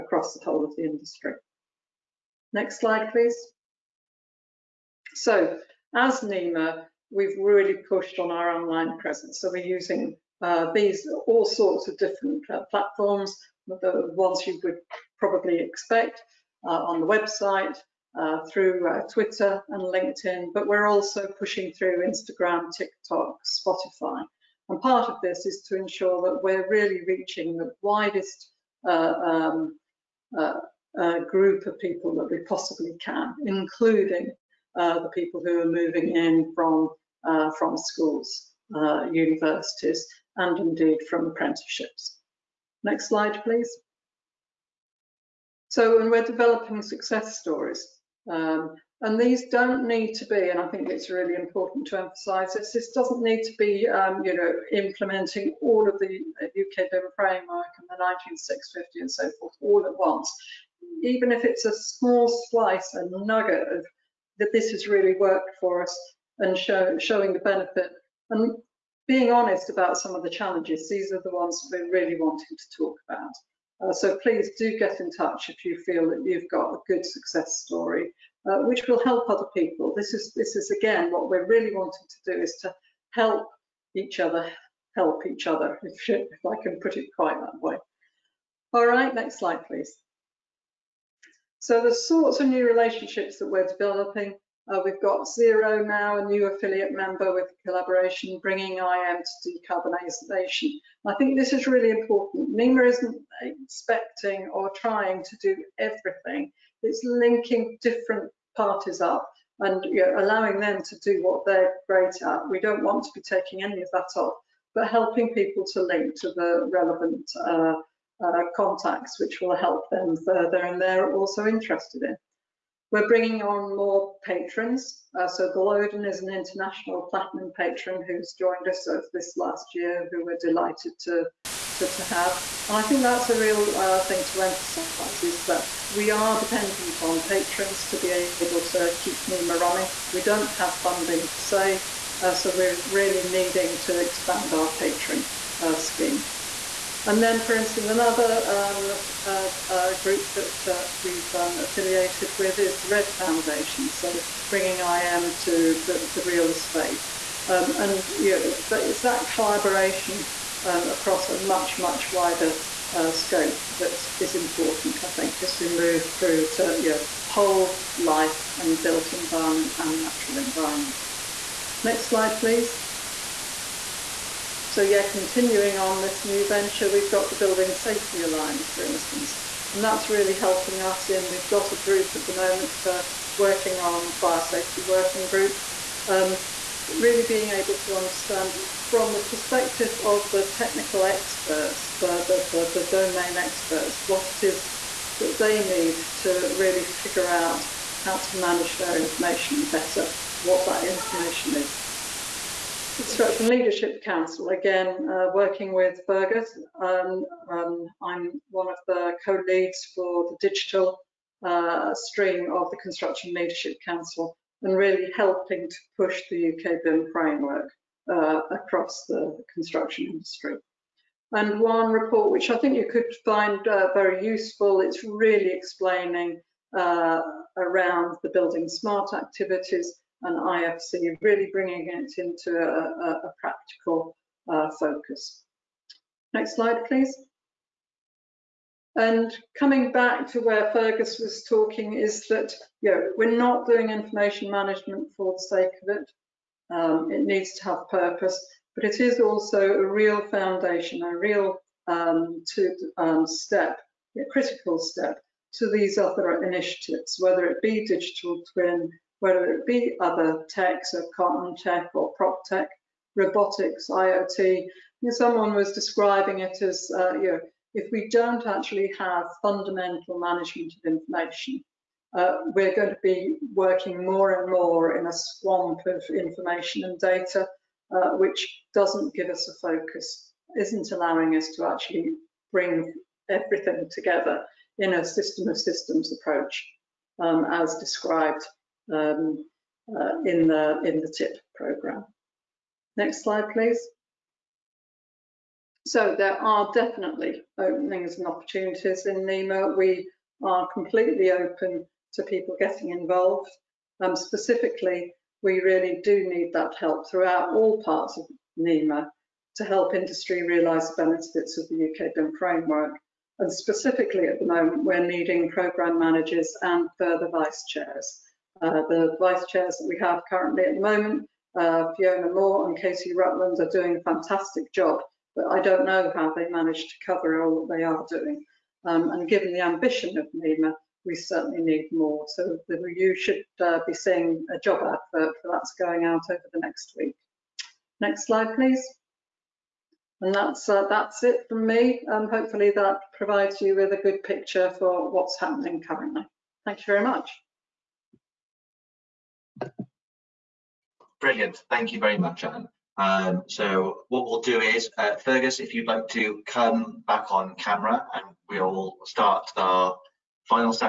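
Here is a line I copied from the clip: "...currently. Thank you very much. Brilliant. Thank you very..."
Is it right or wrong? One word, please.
right.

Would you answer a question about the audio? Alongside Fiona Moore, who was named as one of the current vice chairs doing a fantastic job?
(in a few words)
Casey Rutland.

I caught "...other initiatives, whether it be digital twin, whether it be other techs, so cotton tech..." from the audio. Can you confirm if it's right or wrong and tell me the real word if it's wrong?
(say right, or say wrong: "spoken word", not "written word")
right.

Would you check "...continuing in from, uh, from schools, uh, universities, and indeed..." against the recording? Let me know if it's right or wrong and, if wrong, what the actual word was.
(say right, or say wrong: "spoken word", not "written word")
wrong: "moving", not "continuing".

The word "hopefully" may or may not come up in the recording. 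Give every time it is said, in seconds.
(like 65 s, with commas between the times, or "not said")
342 s.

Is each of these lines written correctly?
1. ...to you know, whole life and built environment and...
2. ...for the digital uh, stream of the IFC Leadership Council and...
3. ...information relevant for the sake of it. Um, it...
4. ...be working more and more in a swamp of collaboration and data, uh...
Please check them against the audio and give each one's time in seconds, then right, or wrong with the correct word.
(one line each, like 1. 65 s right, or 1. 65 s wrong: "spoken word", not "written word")
1. 166 s right
2. 209 s wrong: "Construction", not "IFC"
3. 243 s wrong: "management", not "relevant"
4. 273 s wrong: "information", not "collaboration".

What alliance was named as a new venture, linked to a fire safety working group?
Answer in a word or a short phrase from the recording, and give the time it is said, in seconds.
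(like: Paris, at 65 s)
Building Safety Alliance, at 177 s.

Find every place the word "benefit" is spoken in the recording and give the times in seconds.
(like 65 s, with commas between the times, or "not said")
67 s, 311 s.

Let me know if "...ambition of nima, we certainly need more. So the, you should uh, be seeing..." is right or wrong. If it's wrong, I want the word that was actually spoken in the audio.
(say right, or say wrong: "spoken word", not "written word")
right.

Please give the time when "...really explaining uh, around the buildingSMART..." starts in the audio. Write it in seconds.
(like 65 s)
225 s.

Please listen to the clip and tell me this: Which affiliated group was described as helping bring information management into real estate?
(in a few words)
Red Foundation.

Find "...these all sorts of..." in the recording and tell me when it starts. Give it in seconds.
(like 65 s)
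10 s.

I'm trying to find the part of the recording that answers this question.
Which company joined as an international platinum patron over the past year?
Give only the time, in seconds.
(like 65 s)
125 s.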